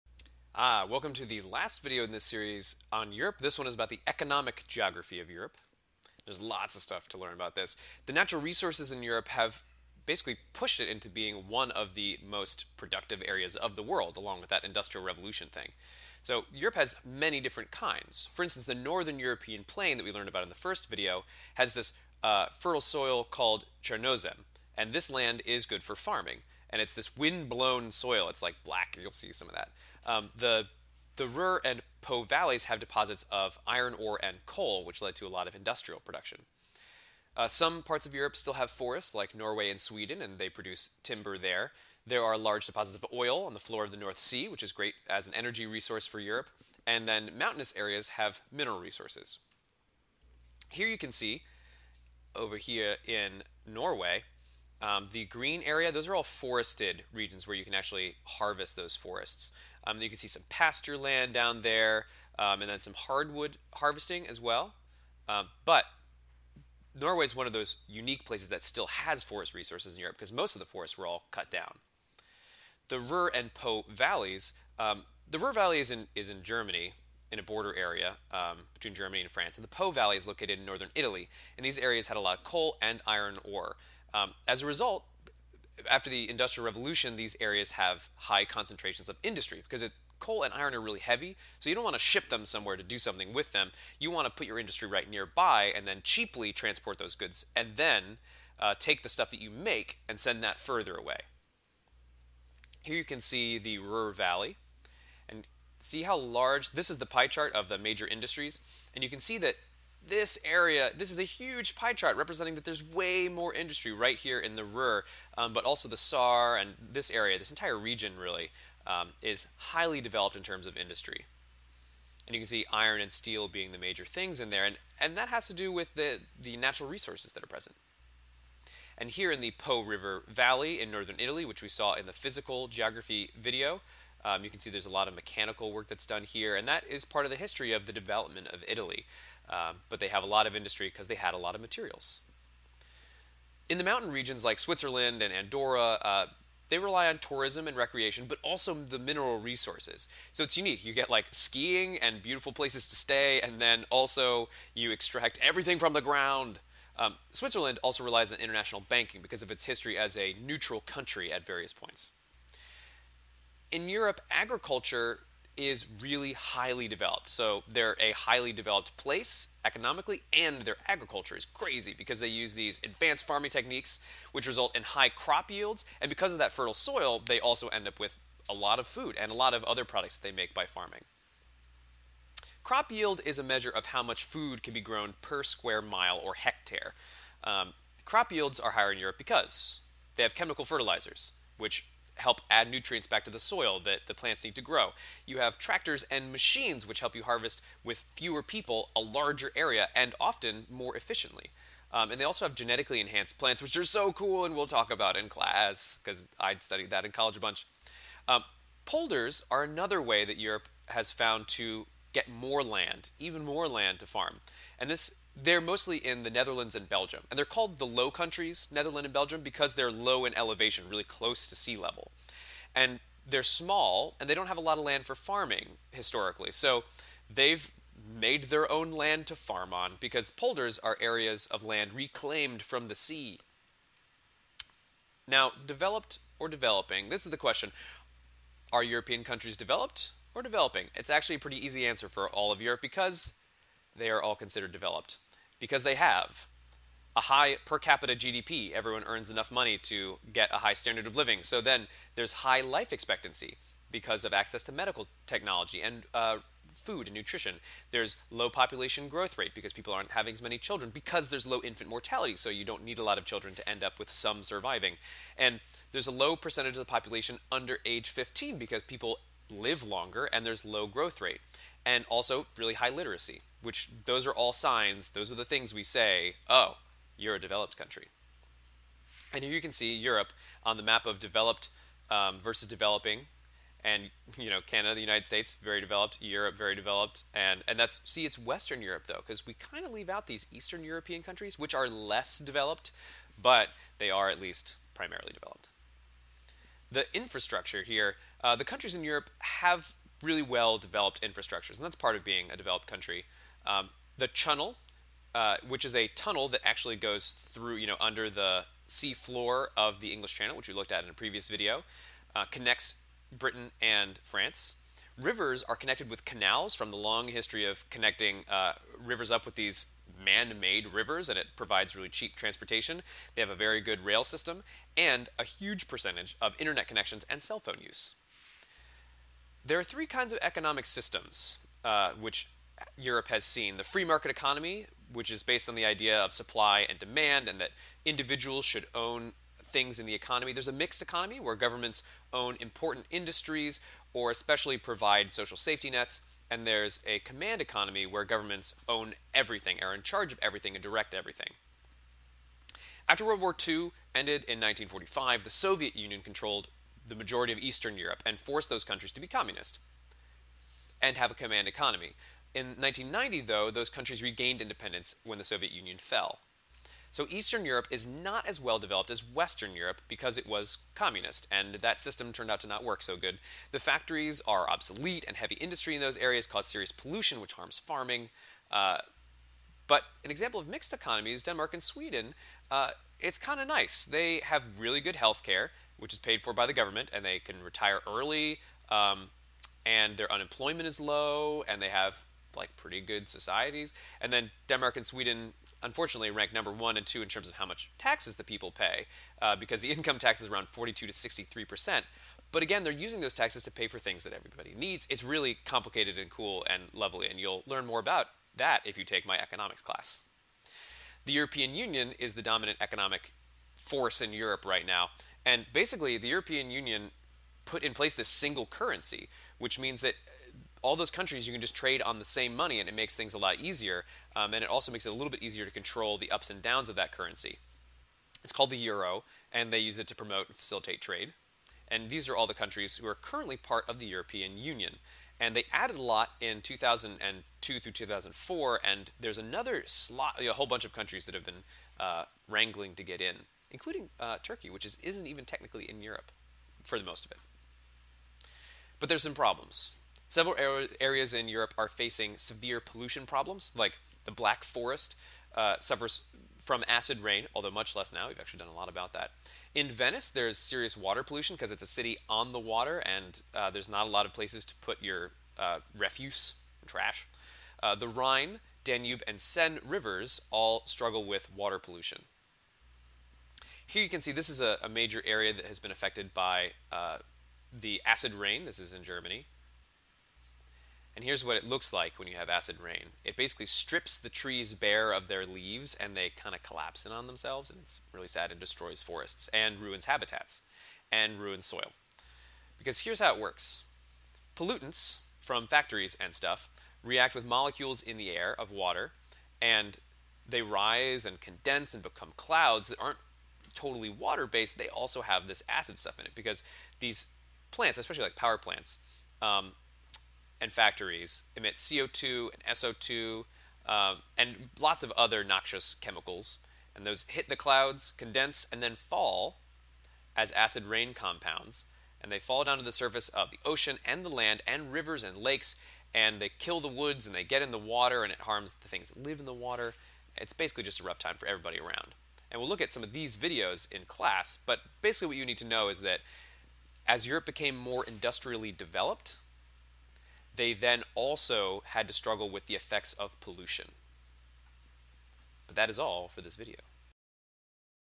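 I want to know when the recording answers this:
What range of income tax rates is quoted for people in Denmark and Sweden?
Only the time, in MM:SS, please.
06:40.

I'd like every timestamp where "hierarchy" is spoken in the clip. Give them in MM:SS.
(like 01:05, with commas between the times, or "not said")
not said.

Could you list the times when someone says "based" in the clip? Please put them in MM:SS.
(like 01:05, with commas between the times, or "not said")
05:35, 08:24.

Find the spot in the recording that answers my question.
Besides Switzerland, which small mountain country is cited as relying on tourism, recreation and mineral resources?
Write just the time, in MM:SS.
02:25.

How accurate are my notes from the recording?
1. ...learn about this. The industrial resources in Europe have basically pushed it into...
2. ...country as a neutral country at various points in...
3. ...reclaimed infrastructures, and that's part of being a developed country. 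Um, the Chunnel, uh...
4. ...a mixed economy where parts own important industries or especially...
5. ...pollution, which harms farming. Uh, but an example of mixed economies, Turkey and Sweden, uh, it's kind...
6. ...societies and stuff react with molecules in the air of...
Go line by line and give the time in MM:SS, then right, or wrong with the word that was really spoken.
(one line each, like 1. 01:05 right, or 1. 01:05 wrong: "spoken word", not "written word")
1. 00:07 wrong: "natural", not "industrial"
2. 02:39 wrong: "history", not "country"
3. 05:00 wrong: "developed", not "reclaimed"
4. 05:40 wrong: "governments", not "parts"
5. 06:16 wrong: "Denmark", not "Turkey"
6. 08:15 wrong: "factories", not "societies".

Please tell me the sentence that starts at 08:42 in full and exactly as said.
And they fall down to the surface of the ocean and the land and rivers and lakes.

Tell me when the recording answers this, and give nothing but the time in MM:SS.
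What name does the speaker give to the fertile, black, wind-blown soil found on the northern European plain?
00:23.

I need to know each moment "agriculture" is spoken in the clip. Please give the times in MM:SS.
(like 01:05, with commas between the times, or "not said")
02:44, 02:50.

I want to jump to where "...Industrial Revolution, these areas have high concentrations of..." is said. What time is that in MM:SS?
01:26.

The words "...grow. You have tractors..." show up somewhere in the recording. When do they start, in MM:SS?
03:14.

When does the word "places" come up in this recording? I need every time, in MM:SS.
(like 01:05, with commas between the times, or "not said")
01:08, 02:32, 02:48, 06:57, 07:44.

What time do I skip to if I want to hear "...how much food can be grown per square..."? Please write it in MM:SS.
03:03.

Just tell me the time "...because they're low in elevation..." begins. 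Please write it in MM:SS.
03:39.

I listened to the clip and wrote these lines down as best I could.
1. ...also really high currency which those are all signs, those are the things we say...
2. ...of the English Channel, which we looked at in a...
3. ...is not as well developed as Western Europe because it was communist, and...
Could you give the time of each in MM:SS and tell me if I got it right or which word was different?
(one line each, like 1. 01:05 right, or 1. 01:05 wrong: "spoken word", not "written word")
1. 04:32 wrong: "literacy", not "currency"
2. 05:09 right
3. 06:07 right.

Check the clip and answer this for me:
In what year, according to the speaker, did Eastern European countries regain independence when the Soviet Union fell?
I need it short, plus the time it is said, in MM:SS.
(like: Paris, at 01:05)
1990, at 06:02.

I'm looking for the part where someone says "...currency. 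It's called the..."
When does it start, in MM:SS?
07:07.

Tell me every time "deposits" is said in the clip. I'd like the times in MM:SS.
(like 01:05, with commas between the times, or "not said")
00:32, 00:42.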